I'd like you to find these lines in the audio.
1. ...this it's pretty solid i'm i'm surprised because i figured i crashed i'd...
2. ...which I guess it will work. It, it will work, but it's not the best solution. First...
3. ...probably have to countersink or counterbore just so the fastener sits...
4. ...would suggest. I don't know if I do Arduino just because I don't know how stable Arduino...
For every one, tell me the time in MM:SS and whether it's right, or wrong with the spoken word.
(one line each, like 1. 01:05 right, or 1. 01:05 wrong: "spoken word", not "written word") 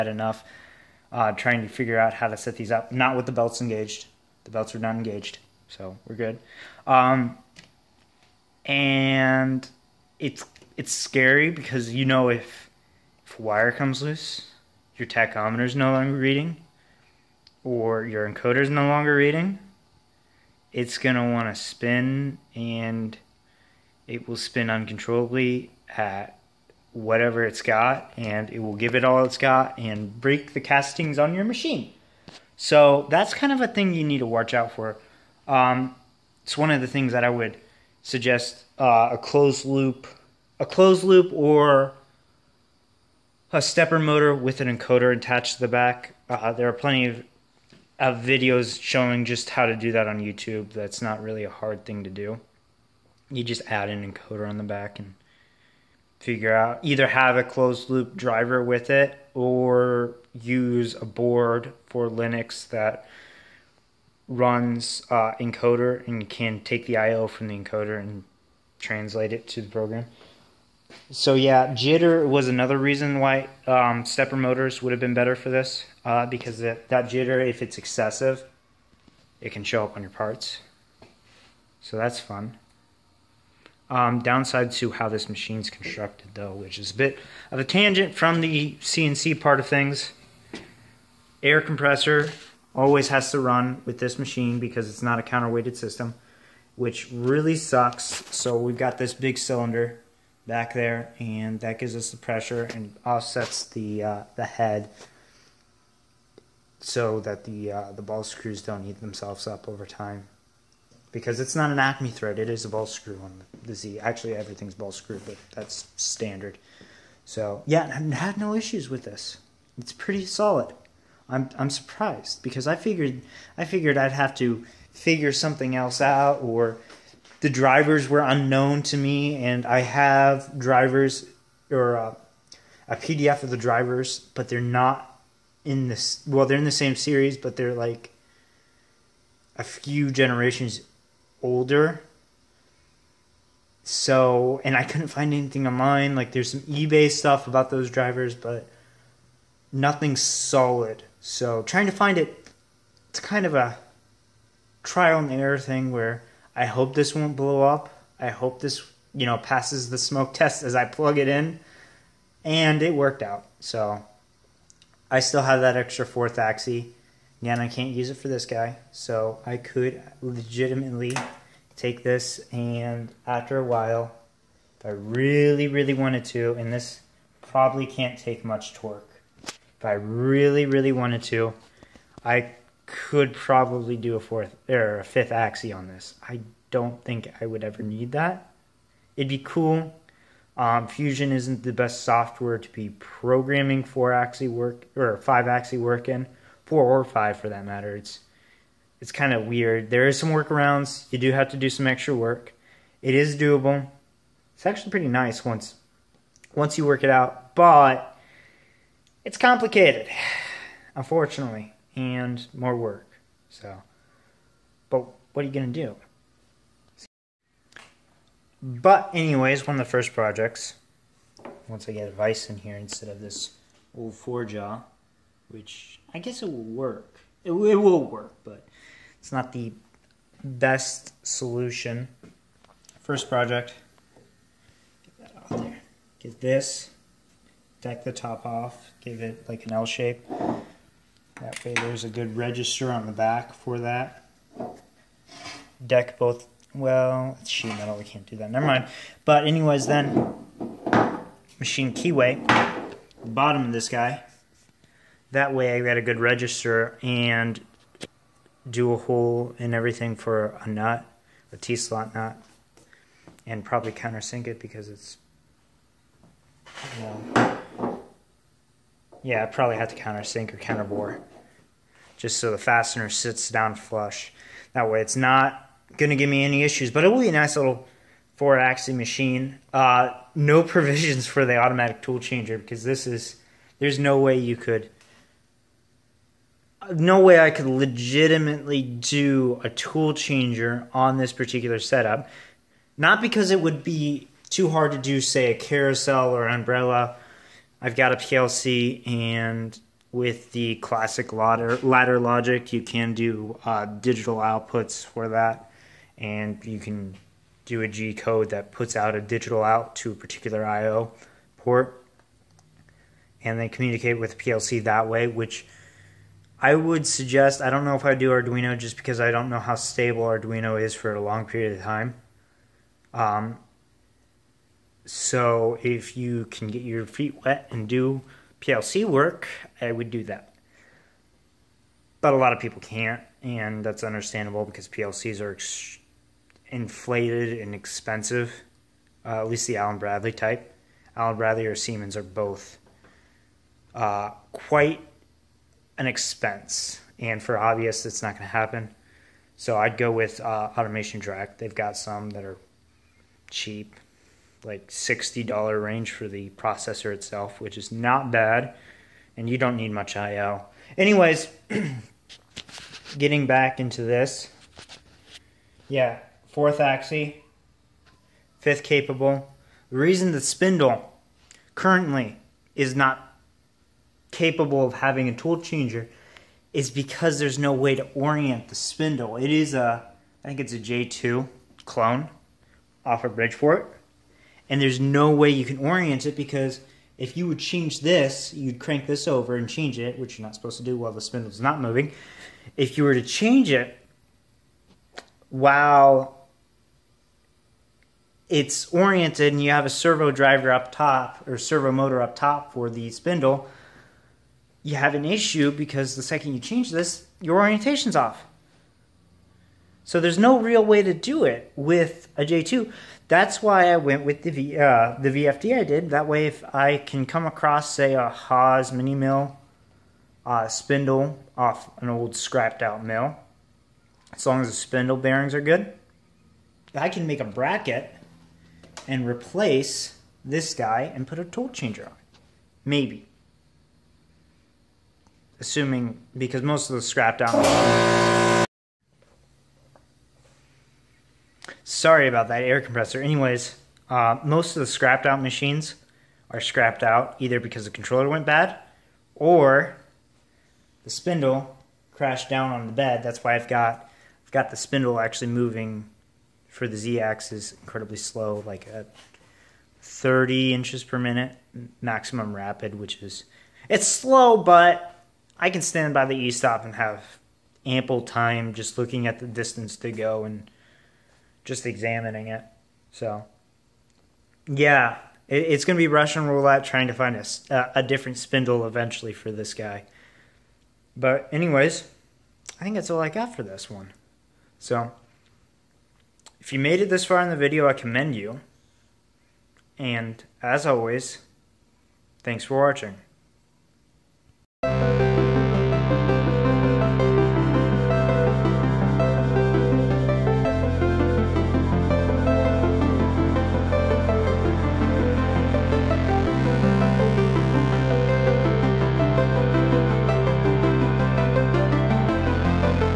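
1. 01:59 wrong: "figured", not "crashed"
2. 03:45 right
3. 04:29 right
4. 05:16 right.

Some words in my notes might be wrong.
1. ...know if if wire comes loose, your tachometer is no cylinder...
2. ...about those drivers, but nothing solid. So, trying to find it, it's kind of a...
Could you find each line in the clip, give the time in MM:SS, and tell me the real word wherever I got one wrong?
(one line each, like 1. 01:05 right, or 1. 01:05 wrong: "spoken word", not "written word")
1. 00:12 wrong: "longer", not "cylinder"
2. 02:27 right.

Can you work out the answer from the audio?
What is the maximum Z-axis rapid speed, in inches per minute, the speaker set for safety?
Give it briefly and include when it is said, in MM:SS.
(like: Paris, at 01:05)
30, at 07:40.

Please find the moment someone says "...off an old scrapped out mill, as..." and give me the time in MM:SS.
07:01.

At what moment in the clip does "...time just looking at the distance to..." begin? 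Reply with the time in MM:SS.
07:48.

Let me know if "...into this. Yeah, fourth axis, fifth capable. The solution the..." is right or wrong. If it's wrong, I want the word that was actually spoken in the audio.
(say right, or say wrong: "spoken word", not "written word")
wrong: "reason", not "solution".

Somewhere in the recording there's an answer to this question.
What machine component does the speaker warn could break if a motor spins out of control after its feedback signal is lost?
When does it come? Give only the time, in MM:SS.
00:30.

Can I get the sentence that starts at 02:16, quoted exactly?
Well, they're in the same series, but they're like a few generations older.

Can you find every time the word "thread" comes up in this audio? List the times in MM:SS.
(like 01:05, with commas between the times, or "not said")
01:52.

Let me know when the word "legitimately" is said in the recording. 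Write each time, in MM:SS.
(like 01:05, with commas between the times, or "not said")
02:50, 04:47.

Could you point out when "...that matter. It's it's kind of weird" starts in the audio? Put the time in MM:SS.
03:17.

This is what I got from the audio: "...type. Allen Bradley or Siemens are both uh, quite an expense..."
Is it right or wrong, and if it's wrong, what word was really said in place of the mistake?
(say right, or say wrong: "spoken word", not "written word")
right.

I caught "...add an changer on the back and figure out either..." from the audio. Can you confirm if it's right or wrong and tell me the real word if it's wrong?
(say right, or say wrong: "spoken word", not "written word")
wrong: "encoder", not "changer".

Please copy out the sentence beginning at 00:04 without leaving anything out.
The belts are not engaged, so we're good.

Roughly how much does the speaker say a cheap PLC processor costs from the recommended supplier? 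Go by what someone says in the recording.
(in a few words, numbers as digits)
$60.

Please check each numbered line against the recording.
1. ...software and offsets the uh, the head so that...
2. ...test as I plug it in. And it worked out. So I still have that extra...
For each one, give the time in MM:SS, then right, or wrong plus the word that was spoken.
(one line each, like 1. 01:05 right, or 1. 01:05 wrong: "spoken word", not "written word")
1. 01:42 wrong: "pressure", not "software"
2. 02:40 right.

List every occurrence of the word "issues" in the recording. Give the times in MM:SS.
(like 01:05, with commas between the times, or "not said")
01:58, 04:36, 06:45.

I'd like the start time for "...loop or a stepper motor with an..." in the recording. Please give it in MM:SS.
00:41.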